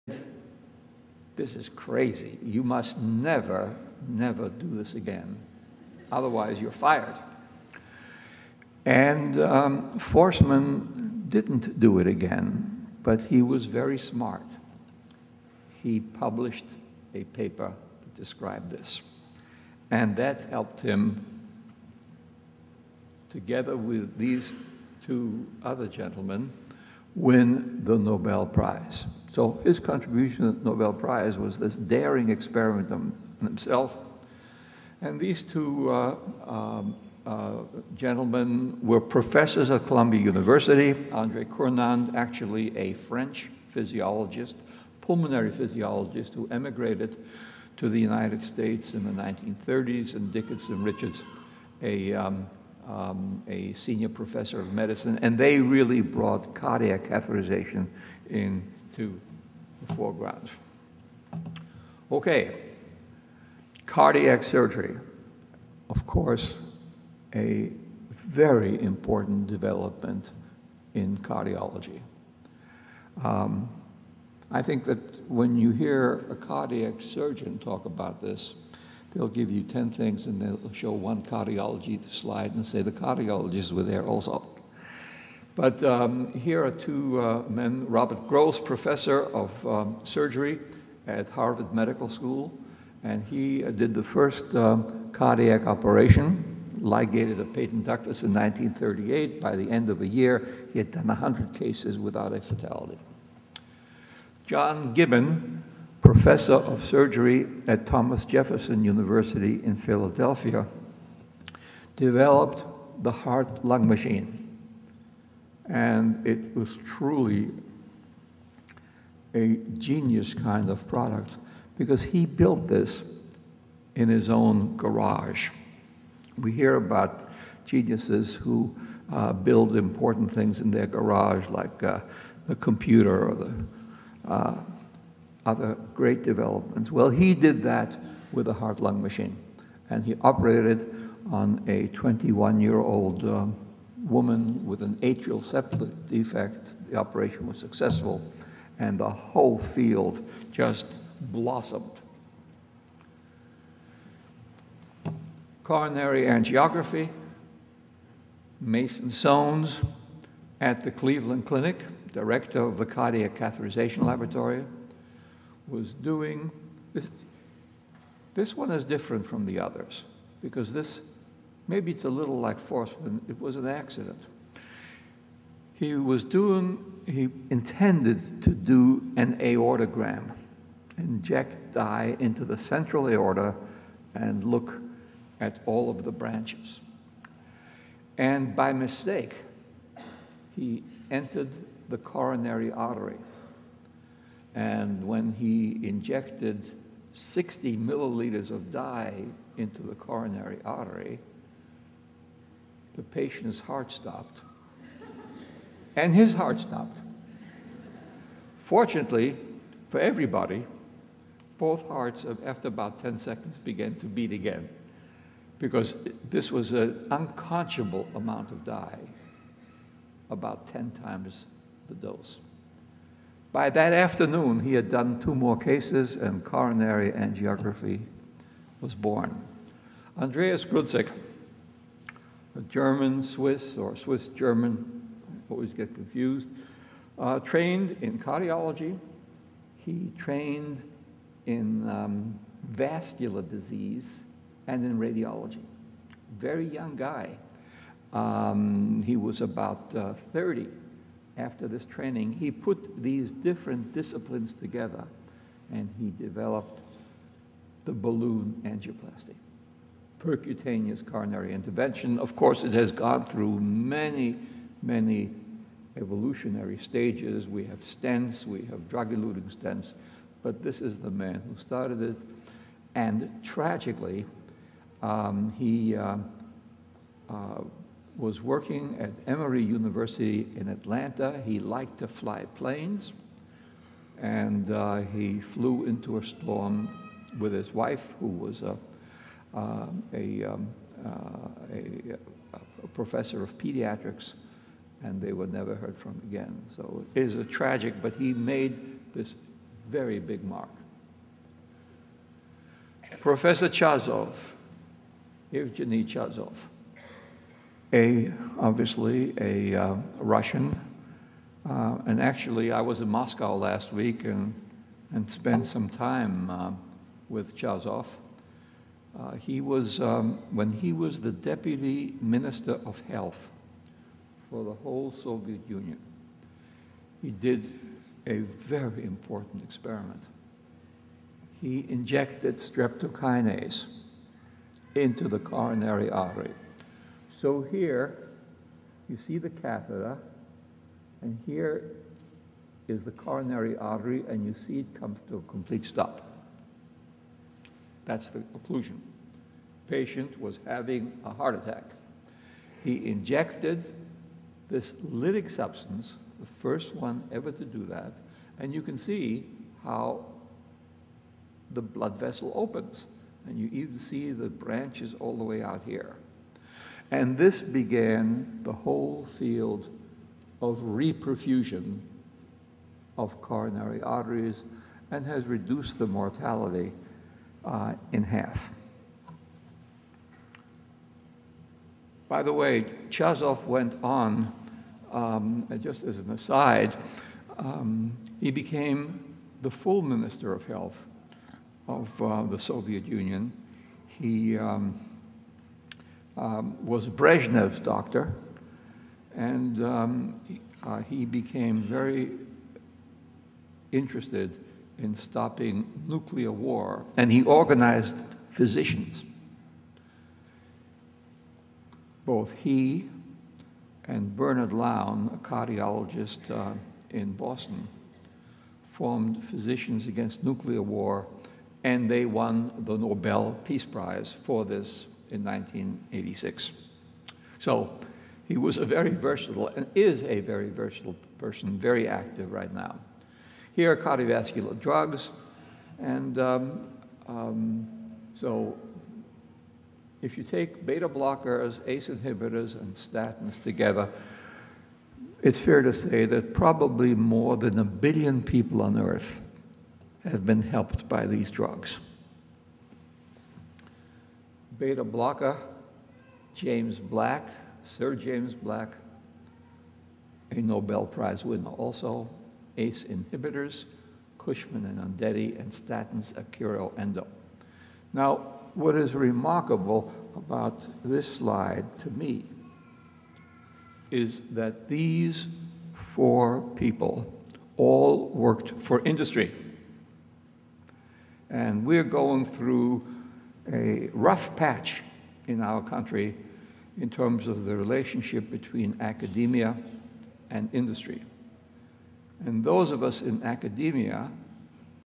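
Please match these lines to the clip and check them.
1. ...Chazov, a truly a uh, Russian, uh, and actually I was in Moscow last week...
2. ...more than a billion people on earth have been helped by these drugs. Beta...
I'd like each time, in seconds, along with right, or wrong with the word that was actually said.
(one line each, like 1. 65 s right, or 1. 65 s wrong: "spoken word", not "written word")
1. 306 s wrong: "obviously", not "truly"
2. 447 s right.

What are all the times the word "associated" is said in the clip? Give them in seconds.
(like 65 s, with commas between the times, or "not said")
not said.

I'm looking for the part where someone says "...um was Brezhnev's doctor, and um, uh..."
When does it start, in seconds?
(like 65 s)
396 s.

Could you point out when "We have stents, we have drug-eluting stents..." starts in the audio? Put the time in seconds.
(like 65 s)
267 s.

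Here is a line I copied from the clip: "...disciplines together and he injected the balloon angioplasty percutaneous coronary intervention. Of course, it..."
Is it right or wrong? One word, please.
wrong.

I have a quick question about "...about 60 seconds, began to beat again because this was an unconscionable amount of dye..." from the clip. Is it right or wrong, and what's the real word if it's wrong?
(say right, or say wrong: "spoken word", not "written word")
wrong: "10", not "60".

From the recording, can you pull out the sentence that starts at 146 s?
The operation was successful, and the whole field just blossomed.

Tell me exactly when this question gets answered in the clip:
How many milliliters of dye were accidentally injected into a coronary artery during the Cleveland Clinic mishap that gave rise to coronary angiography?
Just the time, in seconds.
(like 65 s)
197 s.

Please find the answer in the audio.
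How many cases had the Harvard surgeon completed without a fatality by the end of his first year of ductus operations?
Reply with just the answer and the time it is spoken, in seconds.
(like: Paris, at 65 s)
100, at 101 s.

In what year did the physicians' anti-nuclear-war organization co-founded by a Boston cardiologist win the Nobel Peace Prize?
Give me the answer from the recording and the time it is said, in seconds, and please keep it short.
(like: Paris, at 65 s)
1986, at 425 s.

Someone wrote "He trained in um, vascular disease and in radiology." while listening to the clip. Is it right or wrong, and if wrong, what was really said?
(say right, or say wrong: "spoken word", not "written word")
right.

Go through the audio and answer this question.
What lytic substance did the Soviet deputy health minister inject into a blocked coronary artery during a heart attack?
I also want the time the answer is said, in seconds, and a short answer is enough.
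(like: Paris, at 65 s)
Streptokinase, at 332 s.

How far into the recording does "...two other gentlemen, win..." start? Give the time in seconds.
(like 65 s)
25 s.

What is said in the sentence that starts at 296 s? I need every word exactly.
So it is a tragic, but he made this very big mark.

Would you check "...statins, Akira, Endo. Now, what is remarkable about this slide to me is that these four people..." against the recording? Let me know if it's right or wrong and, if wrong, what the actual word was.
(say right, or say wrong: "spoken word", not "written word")
right.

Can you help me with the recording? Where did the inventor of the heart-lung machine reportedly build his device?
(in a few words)
His own garage.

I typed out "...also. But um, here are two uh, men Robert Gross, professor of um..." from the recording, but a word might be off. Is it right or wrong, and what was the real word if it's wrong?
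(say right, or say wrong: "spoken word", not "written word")
right.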